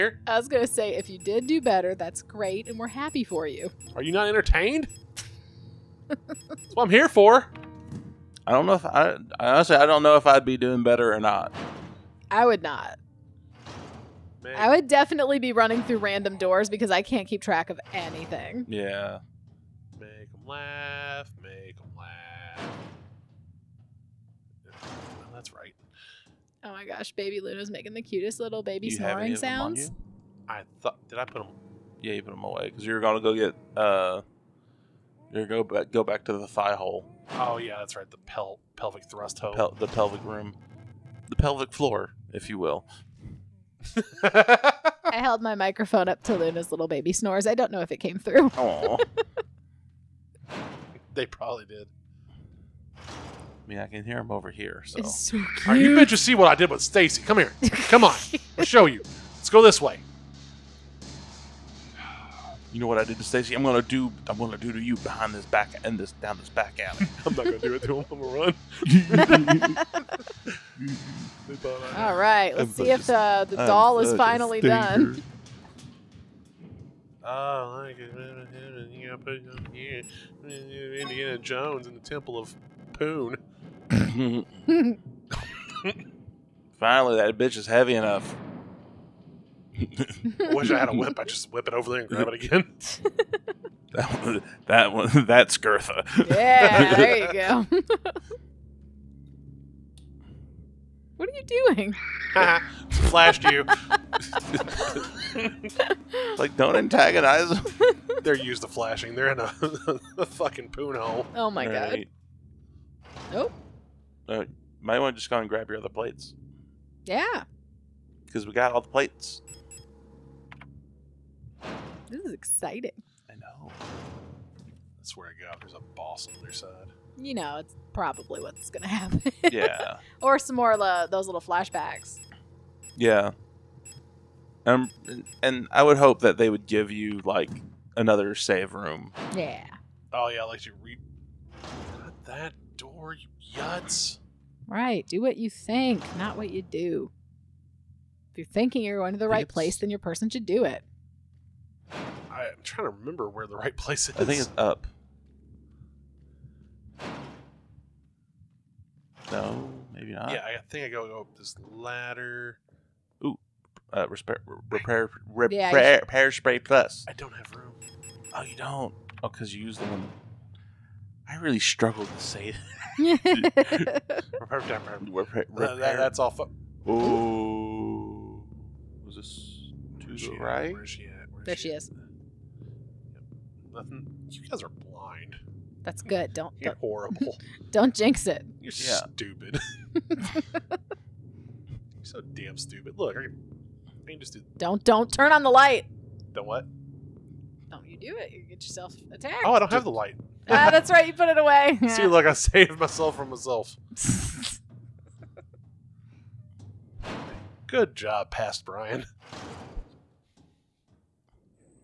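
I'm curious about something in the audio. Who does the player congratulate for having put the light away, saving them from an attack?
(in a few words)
past Brian.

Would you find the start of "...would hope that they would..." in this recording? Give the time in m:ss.
2:15.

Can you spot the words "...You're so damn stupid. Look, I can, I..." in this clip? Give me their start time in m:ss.
3:10.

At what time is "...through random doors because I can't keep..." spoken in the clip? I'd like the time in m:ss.
0:15.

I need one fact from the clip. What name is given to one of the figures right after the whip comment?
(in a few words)
Gertha.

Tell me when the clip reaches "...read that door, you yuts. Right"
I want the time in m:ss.
2:20.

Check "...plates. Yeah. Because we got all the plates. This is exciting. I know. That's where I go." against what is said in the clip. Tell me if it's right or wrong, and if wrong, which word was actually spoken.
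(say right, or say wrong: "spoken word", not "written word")
right.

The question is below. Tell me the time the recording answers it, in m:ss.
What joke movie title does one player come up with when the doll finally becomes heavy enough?
1:20.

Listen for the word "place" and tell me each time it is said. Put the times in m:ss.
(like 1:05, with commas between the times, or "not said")
2:29, 2:33.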